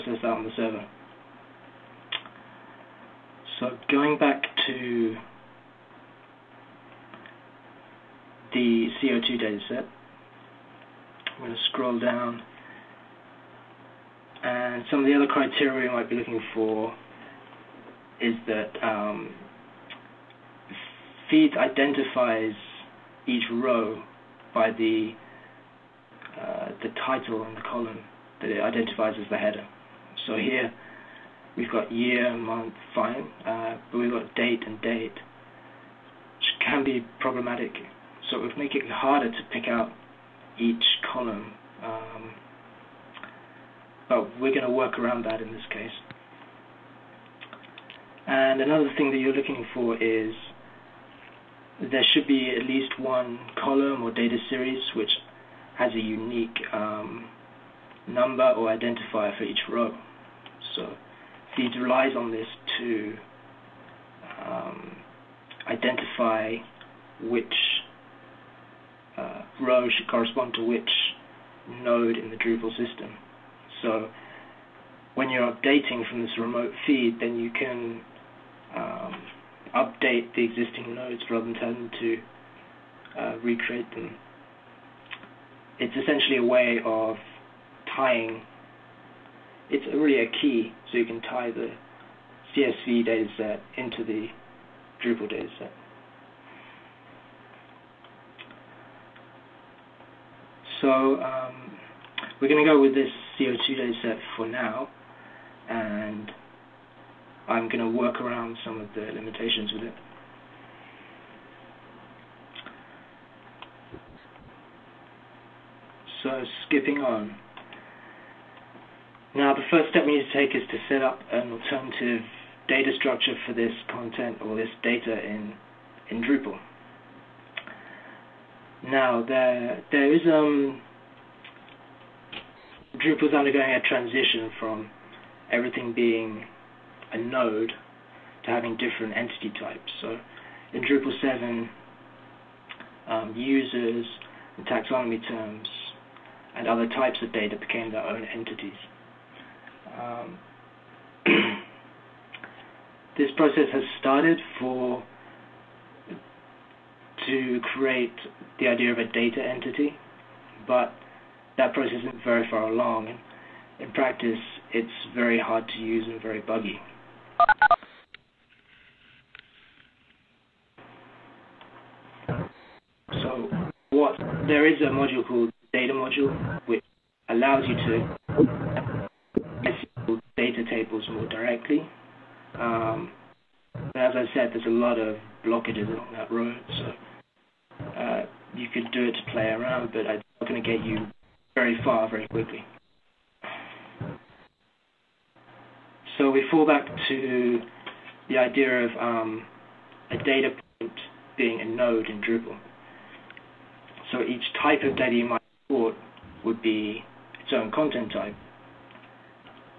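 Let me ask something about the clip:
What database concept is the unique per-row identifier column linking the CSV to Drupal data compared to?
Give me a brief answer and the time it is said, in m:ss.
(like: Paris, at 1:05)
A key, at 1:30.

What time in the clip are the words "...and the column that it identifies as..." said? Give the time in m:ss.
0:27.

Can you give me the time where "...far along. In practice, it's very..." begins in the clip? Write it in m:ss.
2:42.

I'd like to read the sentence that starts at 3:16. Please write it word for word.
So we fall back to the idea of um, a data point being a node in Drupal.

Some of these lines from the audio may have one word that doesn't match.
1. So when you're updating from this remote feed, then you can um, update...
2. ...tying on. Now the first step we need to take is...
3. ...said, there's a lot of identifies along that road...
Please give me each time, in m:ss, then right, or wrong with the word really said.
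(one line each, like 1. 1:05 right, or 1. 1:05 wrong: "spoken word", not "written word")
1. 1:13 right
2. 1:56 wrong: "skipping", not "tying"
3. 3:04 wrong: "blockages", not "identifies".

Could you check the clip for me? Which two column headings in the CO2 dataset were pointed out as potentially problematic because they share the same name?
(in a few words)
Date and date.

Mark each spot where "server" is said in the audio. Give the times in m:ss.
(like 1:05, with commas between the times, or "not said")
0:00.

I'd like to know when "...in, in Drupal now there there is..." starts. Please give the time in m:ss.
2:05.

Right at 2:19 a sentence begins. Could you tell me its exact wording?
So in Drupal 7, um, users and taxonomy terms and other types of data became their own entities.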